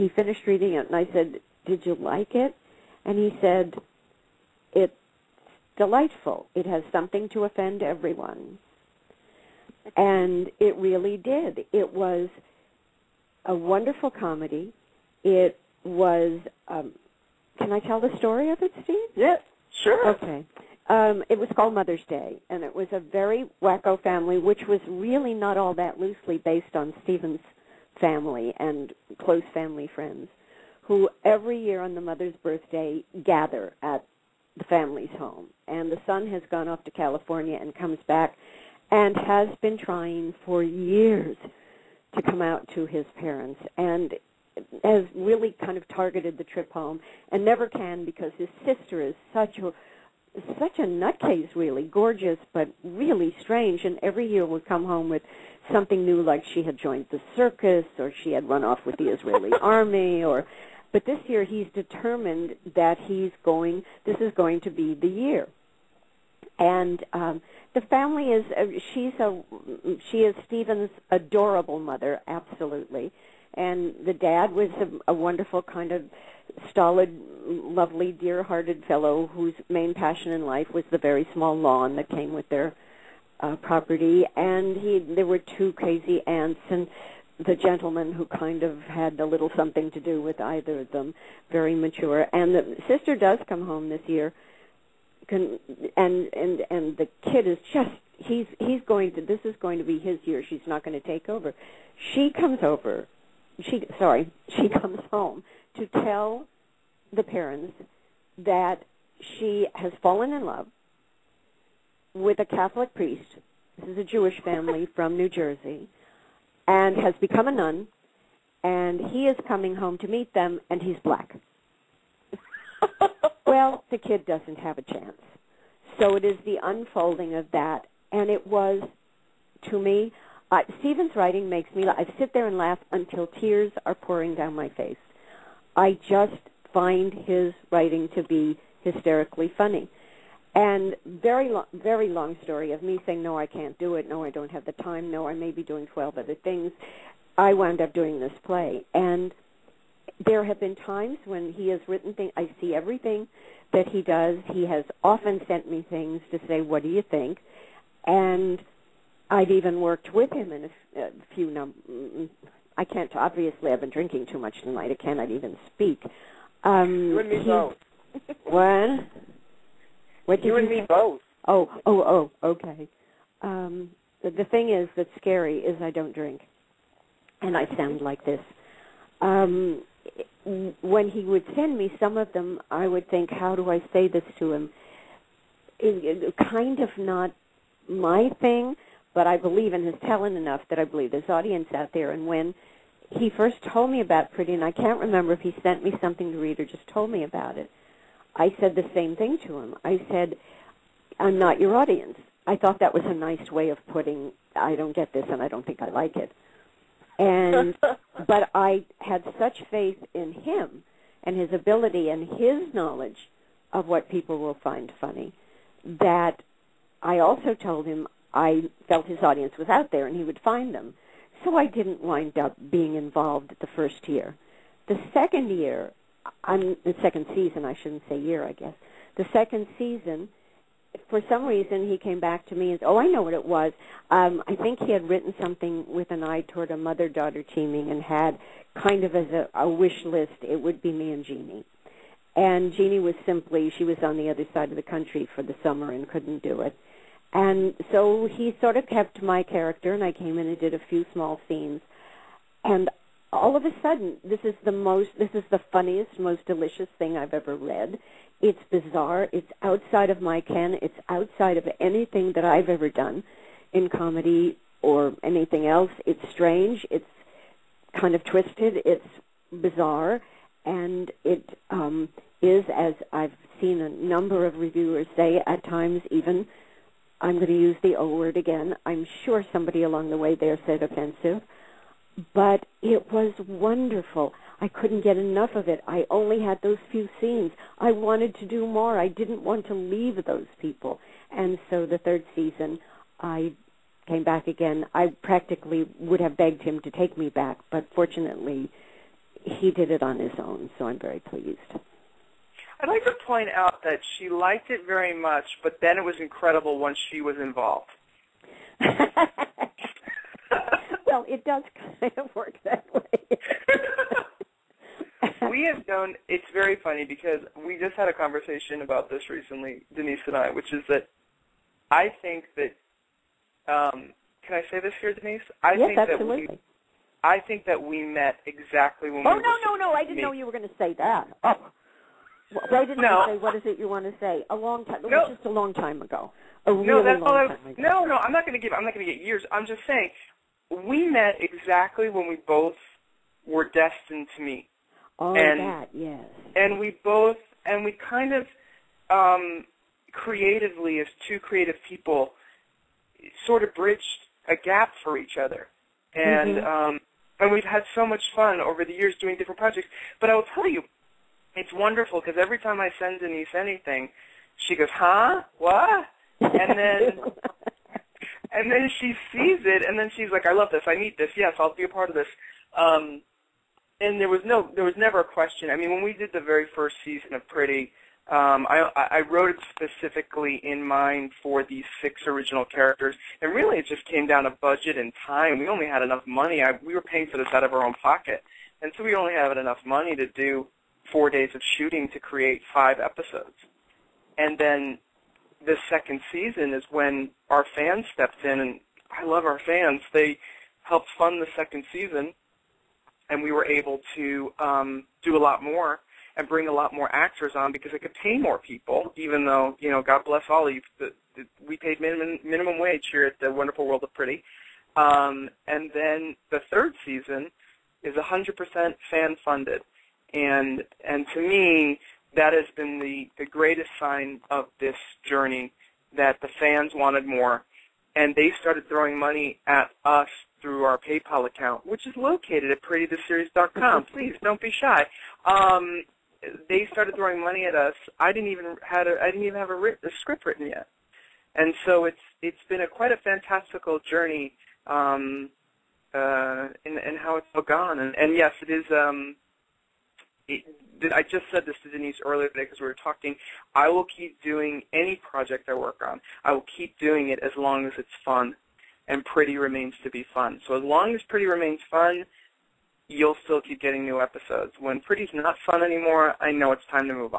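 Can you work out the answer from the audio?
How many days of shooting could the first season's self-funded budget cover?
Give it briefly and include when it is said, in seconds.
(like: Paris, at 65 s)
4, at 391 s.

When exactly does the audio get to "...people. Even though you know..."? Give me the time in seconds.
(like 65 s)
408 s.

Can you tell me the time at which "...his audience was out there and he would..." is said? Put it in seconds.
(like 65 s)
219 s.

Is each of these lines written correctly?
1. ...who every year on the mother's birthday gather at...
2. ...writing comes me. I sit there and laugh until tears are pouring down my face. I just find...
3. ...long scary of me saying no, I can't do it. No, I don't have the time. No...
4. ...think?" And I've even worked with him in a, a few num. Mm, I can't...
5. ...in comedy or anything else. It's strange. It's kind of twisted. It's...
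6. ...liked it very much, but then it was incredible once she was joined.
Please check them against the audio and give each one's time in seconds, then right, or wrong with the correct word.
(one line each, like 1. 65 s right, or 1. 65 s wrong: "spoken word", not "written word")
1. 30 s right
2. 131 s wrong: "makes", not "comes"
3. 142 s wrong: "story", not "scary"
4. 157 s right
5. 263 s right
6. 304 s wrong: "involved", not "joined".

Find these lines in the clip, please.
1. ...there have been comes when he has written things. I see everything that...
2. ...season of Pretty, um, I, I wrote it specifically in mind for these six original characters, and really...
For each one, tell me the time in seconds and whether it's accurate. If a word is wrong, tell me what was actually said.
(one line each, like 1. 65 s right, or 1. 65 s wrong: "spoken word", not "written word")
1. 150 s wrong: "times", not "comes"
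2. 377 s right.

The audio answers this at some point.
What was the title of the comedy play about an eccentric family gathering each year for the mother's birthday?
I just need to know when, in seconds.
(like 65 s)
21 s.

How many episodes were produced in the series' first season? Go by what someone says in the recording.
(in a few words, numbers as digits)
5.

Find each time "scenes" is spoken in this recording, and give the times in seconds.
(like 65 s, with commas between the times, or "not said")
251 s, 287 s.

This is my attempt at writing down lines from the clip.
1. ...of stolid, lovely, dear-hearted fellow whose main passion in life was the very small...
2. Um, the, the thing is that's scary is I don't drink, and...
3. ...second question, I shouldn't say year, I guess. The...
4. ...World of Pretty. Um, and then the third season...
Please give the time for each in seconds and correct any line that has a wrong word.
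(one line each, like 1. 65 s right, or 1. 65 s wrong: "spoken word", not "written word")
1. 75 s right
2. 173 s right
3. 227 s wrong: "season", not "question"
4. 413 s right.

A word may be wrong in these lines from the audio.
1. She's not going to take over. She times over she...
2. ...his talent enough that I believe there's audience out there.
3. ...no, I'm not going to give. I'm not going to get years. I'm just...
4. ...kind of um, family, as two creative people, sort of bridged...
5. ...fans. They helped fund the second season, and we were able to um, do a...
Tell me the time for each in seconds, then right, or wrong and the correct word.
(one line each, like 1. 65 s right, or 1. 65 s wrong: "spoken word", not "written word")
1. 100 s wrong: "comes", not "times"
2. 189 s right
3. 338 s right
4. 348 s wrong: "creatively", not "family"
5. 399 s right.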